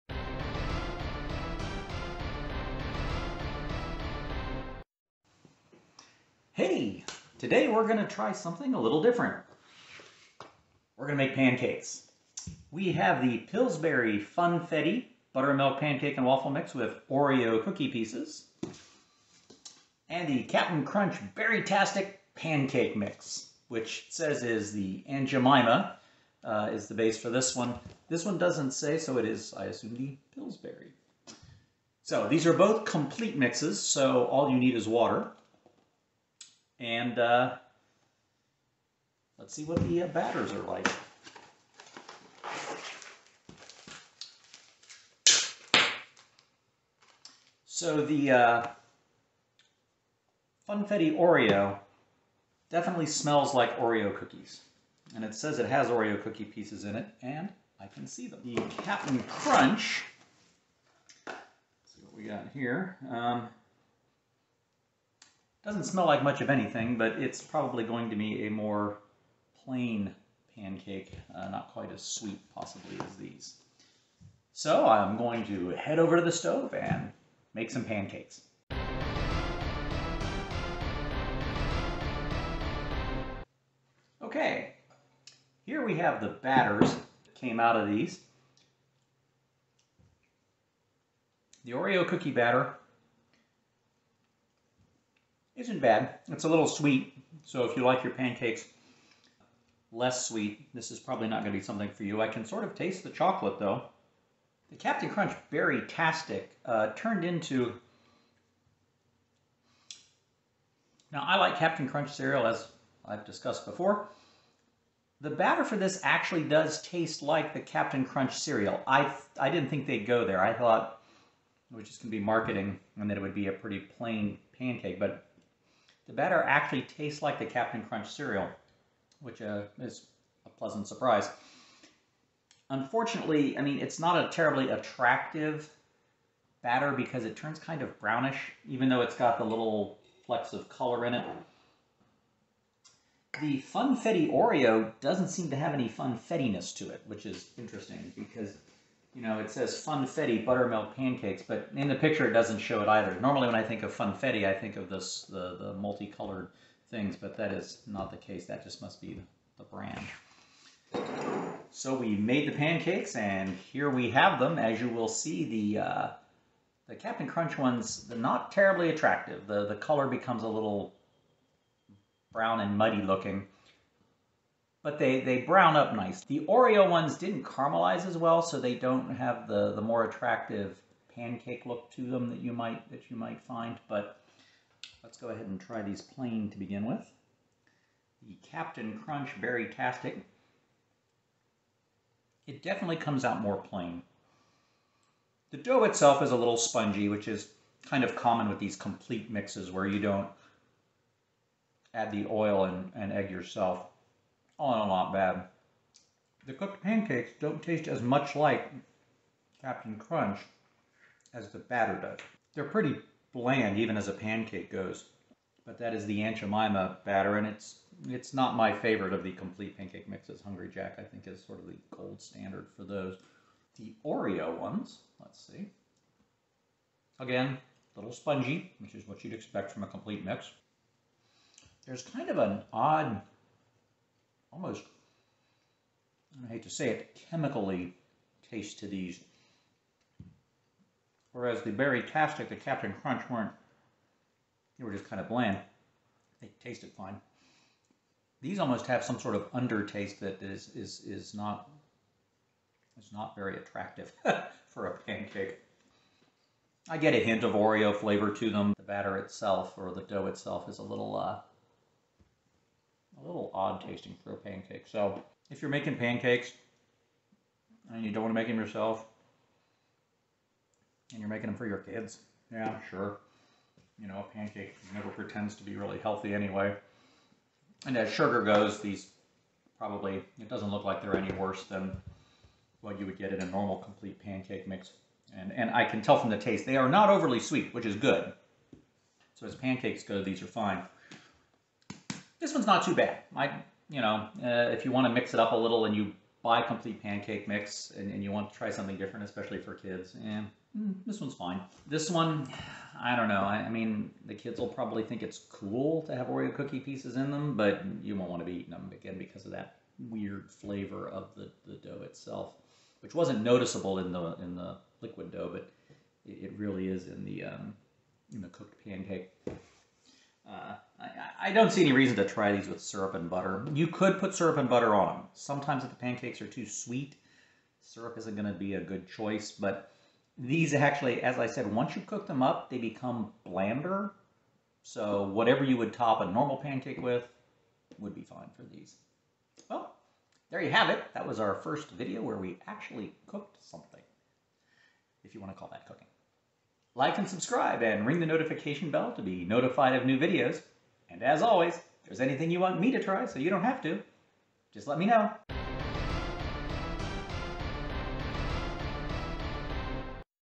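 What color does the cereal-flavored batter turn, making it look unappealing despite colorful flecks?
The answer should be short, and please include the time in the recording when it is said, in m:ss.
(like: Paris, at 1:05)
Brownish, at 2:17.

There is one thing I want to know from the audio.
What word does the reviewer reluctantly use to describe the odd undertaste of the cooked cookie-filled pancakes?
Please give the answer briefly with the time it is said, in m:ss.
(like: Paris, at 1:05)
Chemically, at 3:57.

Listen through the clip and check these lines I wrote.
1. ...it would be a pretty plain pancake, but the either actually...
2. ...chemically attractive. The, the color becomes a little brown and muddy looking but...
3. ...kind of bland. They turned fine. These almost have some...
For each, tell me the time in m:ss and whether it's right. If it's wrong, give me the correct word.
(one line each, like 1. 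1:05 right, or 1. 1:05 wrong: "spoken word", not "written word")
1. 2:03 wrong: "batter", not "either"
2. 2:48 wrong: "terribly", not "chemically"
3. 4:05 wrong: "tasted", not "turned".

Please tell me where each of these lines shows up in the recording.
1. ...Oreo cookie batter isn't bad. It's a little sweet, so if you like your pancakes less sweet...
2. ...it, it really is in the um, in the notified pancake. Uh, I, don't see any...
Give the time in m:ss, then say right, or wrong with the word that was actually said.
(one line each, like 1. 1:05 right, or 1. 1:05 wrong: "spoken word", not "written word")
1. 1:31 right
2. 5:16 wrong: "cooked", not "notified".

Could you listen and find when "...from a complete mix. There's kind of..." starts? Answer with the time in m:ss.
3:49.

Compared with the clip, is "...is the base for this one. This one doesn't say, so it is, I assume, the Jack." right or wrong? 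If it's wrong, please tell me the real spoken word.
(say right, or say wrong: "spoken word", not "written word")
wrong: "Pillsbury", not "Jack".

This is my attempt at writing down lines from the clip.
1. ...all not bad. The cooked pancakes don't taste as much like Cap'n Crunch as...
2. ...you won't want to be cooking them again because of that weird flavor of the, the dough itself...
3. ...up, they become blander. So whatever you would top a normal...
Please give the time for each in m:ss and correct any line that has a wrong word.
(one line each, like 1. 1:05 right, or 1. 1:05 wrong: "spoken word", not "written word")
1. 3:24 right
2. 5:08 wrong: "eating", not "cooking"
3. 5:32 right.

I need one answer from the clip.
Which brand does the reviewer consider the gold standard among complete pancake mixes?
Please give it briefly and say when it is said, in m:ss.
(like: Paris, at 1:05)
Hungry Jack, at 3:40.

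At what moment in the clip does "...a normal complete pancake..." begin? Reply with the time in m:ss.
4:43.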